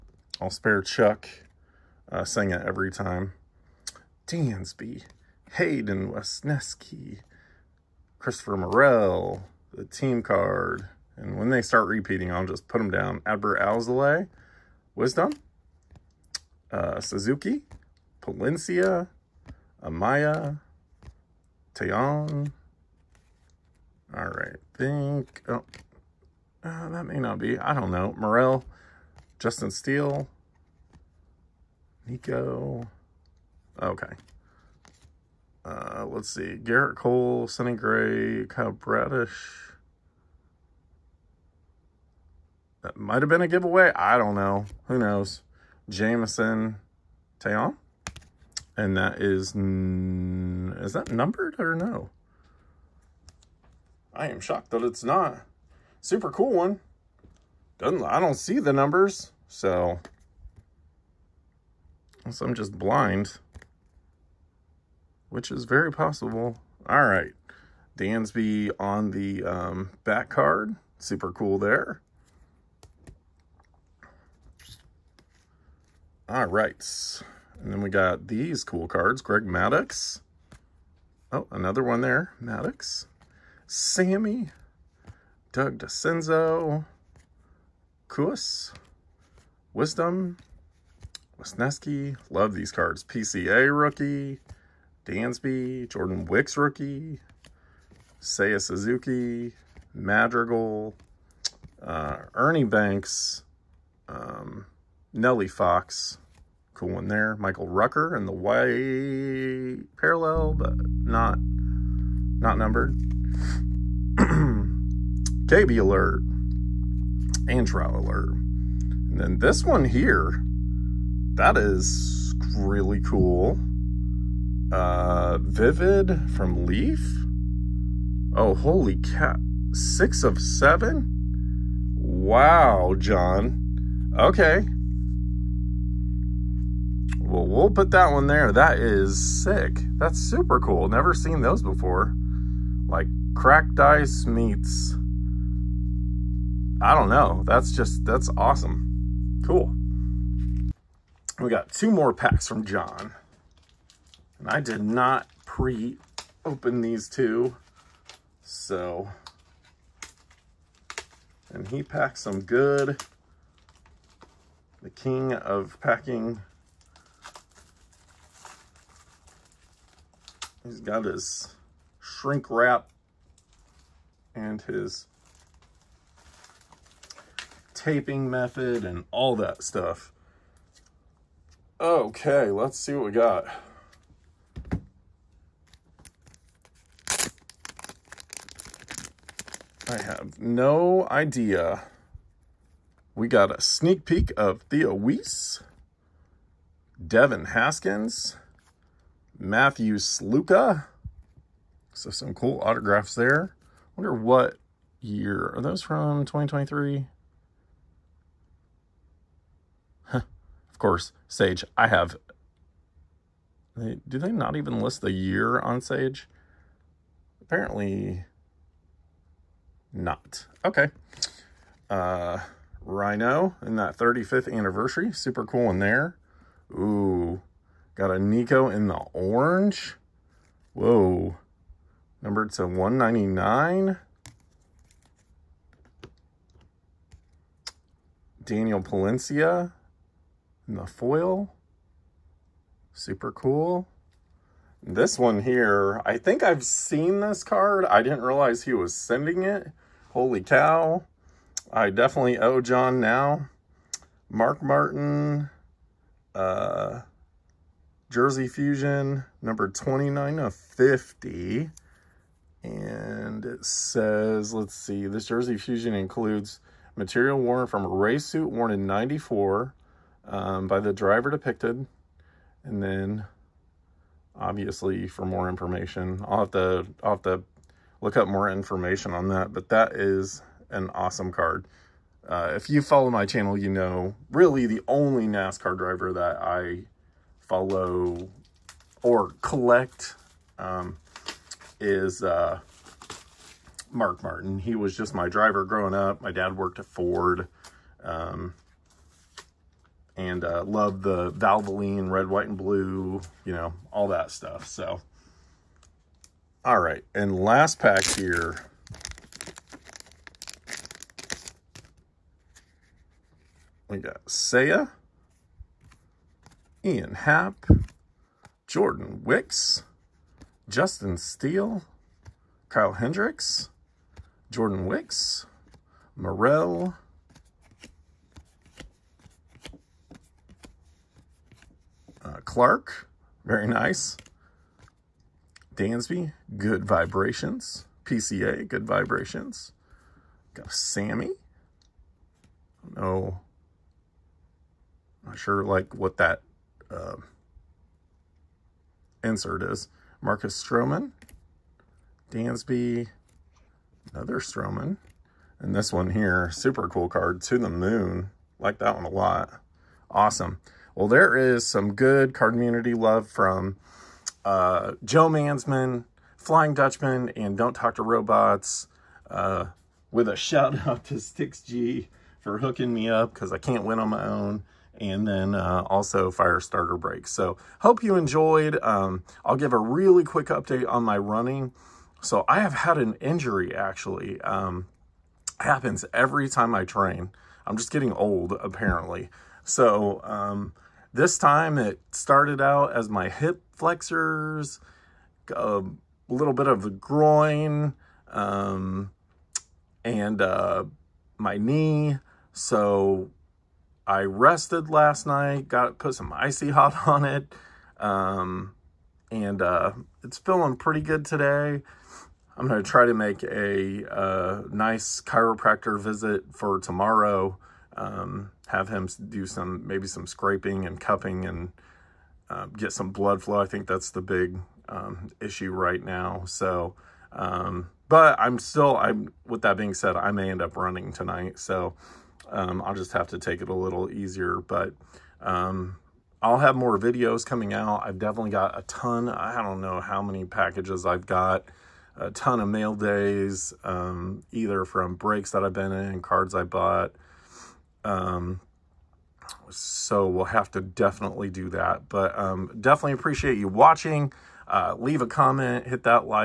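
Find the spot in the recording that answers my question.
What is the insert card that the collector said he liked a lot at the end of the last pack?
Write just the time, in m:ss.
5:57.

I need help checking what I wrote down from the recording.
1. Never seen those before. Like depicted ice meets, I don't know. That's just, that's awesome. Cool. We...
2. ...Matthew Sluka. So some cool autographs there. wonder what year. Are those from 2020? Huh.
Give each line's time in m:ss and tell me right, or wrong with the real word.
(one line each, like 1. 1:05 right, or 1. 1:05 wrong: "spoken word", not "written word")
1. 2:20 wrong: "cracked", not "depicted"
2. 3:19 wrong: "2023", not "2020".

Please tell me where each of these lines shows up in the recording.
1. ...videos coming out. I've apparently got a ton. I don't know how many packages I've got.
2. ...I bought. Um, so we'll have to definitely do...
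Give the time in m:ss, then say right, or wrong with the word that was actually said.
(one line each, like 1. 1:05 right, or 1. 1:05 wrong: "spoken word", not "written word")
1. 7:16 wrong: "definitely", not "apparently"
2. 7:26 right.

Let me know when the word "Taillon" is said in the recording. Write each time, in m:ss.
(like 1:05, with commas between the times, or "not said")
0:21, 0:47.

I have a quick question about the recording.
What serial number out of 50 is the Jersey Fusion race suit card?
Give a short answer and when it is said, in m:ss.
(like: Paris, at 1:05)
29, at 4:19.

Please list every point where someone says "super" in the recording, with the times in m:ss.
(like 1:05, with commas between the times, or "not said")
0:56, 1:10, 2:20, 3:45, 4:02, 5:56.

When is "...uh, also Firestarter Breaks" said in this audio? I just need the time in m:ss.
6:15.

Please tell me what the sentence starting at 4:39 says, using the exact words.
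But that is an awesome card.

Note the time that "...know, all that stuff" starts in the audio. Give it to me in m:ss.
5:03.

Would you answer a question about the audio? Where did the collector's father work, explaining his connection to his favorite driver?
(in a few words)
Ford.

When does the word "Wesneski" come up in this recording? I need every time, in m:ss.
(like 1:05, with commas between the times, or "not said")
0:06, 1:31.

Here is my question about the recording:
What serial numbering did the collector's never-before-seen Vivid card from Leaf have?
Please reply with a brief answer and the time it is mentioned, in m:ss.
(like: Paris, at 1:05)
6 of 7, at 2:09.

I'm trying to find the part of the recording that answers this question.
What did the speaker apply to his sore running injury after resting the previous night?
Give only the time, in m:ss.
6:46.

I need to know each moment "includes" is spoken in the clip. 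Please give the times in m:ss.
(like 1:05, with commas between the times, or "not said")
4:25.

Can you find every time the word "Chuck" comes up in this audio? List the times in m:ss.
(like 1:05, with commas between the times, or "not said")
0:00.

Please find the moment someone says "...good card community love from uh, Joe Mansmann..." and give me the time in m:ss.
6:01.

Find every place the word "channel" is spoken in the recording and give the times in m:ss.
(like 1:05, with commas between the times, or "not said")
4:43.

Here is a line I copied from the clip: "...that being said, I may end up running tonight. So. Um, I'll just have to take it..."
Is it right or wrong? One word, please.
right.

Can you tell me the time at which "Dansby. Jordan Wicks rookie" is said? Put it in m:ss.
1:35.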